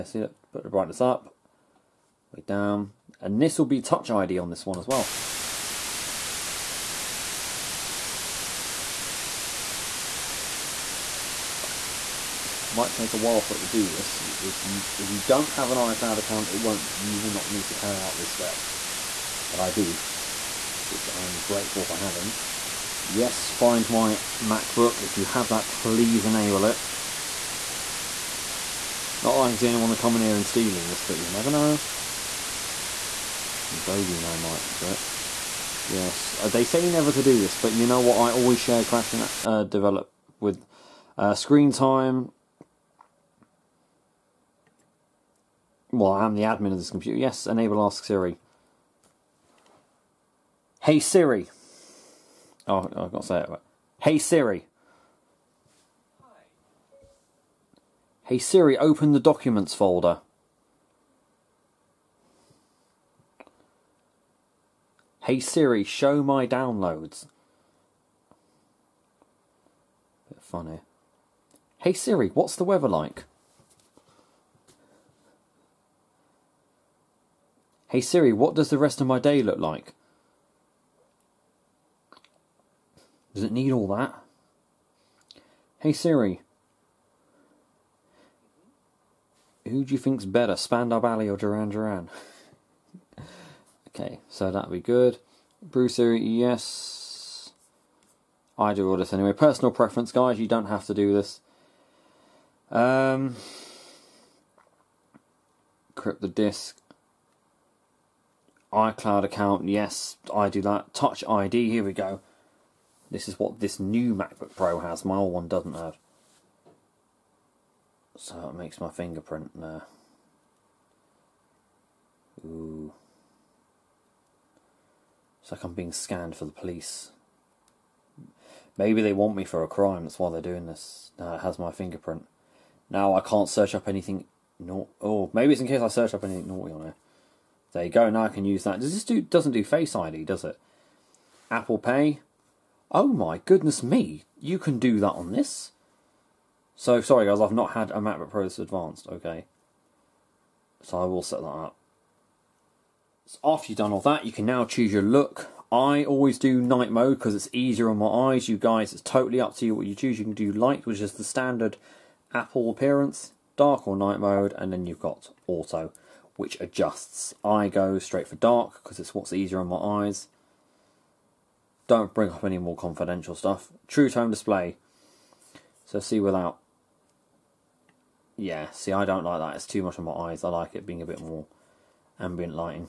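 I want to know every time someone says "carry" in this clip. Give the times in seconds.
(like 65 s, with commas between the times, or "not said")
17 s.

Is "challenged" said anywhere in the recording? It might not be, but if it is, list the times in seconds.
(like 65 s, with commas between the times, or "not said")
not said.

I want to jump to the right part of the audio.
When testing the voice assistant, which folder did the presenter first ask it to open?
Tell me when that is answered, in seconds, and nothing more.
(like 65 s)
59 s.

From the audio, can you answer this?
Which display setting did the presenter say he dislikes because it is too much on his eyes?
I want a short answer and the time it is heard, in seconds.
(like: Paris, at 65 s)
True Tone, at 173 s.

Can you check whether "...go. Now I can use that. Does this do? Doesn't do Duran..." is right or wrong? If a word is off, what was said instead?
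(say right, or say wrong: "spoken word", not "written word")
wrong: "Face", not "Duran".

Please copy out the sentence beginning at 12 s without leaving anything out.
Might take a while for it to do this.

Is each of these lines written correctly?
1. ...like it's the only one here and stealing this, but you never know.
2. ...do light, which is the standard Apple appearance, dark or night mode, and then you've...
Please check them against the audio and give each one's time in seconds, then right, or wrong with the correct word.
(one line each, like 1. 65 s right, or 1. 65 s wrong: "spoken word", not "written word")
1. 29 s right
2. 160 s right.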